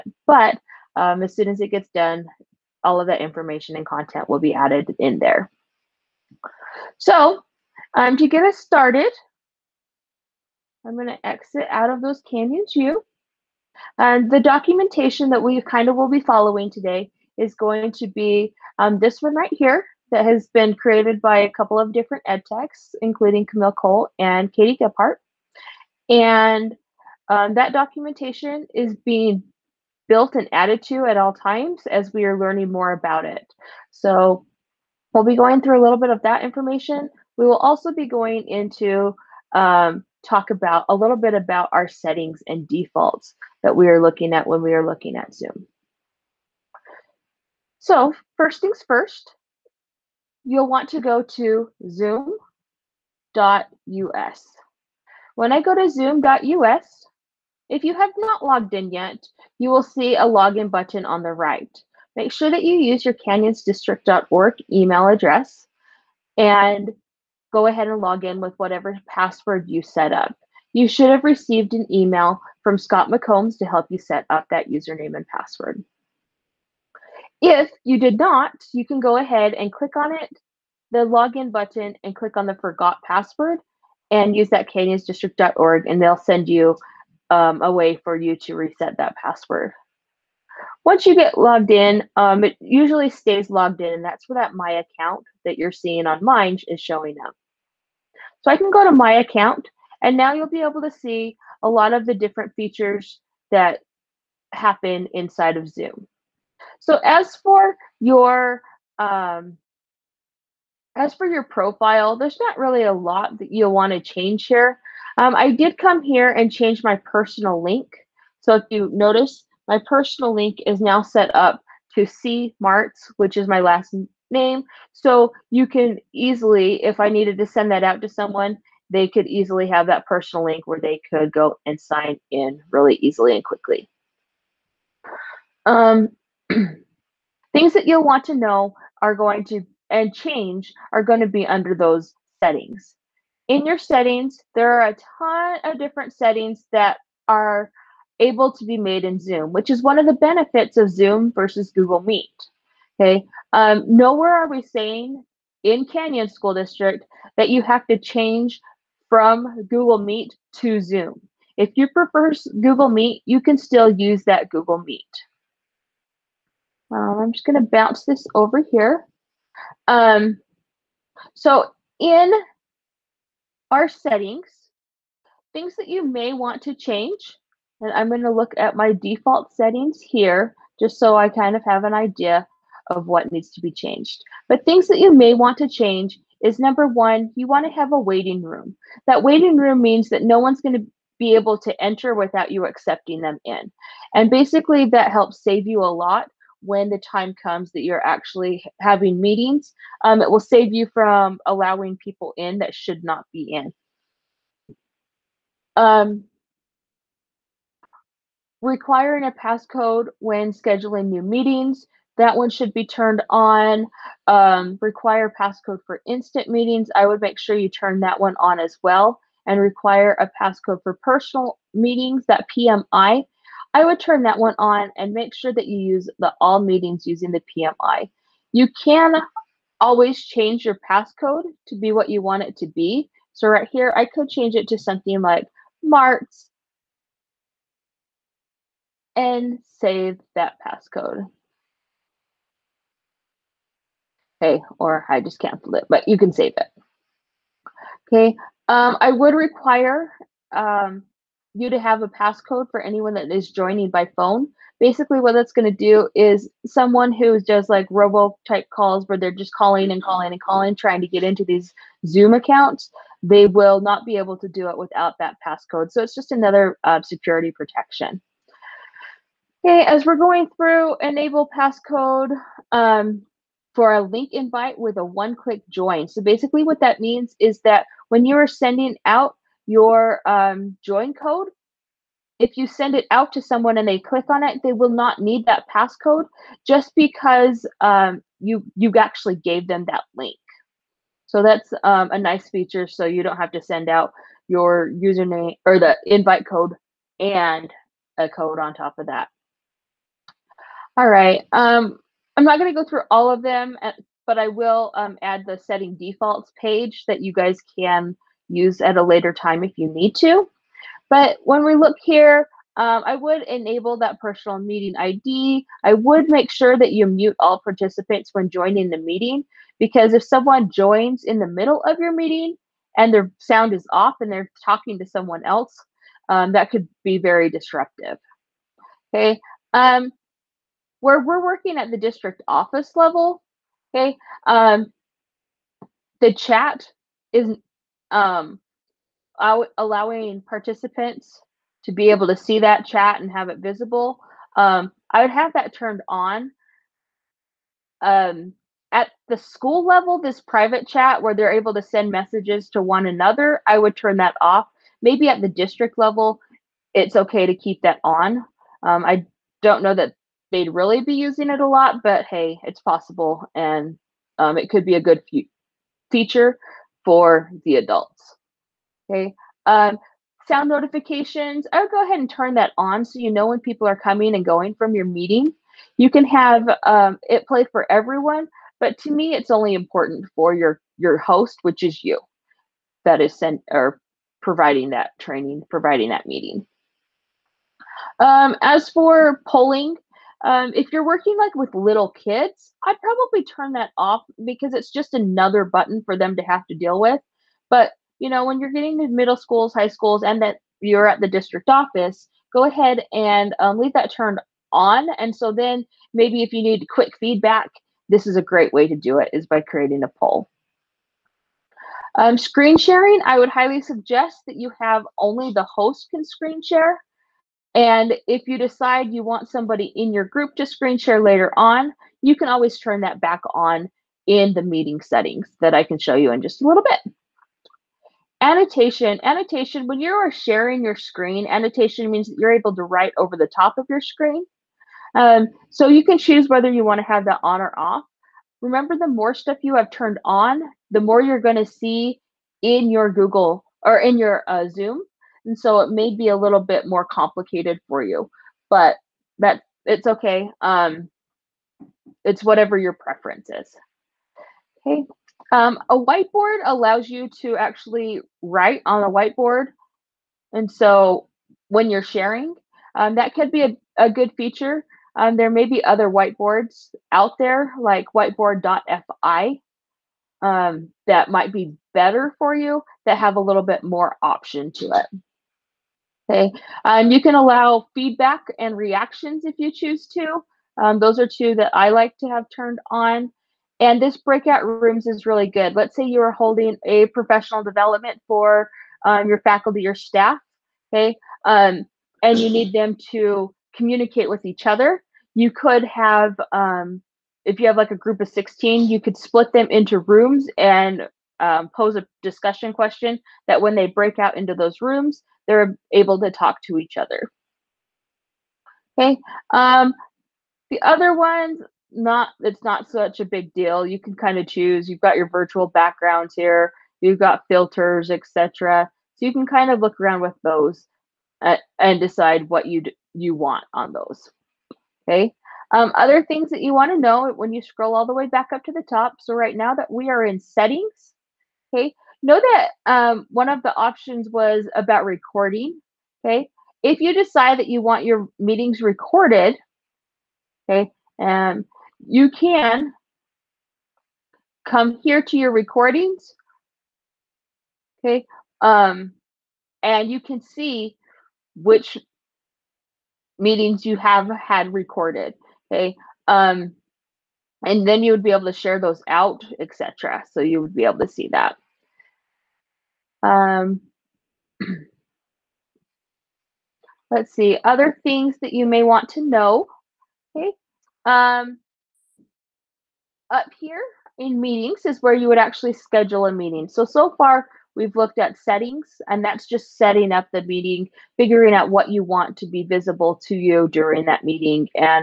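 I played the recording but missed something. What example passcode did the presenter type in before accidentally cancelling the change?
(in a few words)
Marts.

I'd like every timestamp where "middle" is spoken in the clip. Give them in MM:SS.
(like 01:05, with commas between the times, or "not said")
05:21, 06:39.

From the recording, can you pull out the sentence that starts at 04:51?
So that's um, a nice feature.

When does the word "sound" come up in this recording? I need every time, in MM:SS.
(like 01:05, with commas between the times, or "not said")
05:23, 06:10.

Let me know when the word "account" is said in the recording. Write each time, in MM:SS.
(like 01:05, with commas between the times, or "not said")
01:34, 01:39, 04:22.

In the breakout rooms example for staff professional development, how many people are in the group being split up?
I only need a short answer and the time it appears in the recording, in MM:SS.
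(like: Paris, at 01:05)
16, at 08:18.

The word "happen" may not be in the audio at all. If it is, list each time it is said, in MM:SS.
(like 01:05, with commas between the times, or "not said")
01:44.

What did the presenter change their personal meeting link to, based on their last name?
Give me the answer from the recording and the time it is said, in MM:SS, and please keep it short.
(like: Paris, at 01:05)
C Martz, at 02:02.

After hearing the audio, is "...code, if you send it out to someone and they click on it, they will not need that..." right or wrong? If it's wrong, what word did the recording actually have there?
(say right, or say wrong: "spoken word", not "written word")
right.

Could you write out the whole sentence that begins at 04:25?
So it's just another uh, security protection.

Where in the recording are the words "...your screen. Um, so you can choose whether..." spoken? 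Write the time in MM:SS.
07:13.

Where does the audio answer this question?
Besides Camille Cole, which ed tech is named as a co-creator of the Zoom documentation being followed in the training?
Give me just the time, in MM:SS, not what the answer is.
00:24.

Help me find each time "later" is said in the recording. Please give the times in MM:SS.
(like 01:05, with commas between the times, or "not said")
05:09, 07:01.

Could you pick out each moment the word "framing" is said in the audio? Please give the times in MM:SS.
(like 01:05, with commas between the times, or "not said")
not said.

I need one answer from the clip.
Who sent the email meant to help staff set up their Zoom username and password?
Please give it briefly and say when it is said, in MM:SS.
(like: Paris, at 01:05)
Scott McCombs, at 01:12.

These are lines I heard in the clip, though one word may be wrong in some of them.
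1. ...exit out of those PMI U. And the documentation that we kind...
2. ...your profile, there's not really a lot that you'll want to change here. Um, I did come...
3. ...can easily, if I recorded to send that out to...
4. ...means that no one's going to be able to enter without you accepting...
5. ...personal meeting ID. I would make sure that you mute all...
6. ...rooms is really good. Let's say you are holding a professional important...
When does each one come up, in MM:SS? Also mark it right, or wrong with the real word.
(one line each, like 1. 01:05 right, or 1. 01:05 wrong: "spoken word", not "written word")
1. 00:11 wrong: "Canyons", not "PMI"
2. 01:51 right
3. 02:05 wrong: "needed", not "recorded"
4. 03:09 right
5. 05:14 right
6. 08:04 wrong: "development", not "important".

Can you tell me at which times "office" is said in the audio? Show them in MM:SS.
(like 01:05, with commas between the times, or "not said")
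05:32, 06:41.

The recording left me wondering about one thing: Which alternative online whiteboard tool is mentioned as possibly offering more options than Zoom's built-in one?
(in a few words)
whiteboard.fi.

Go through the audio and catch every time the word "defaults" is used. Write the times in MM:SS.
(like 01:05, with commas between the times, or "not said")
00:42, 02:58, 05:05.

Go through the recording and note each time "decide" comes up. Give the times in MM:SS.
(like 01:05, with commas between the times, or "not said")
06:58, 08:41, 08:57.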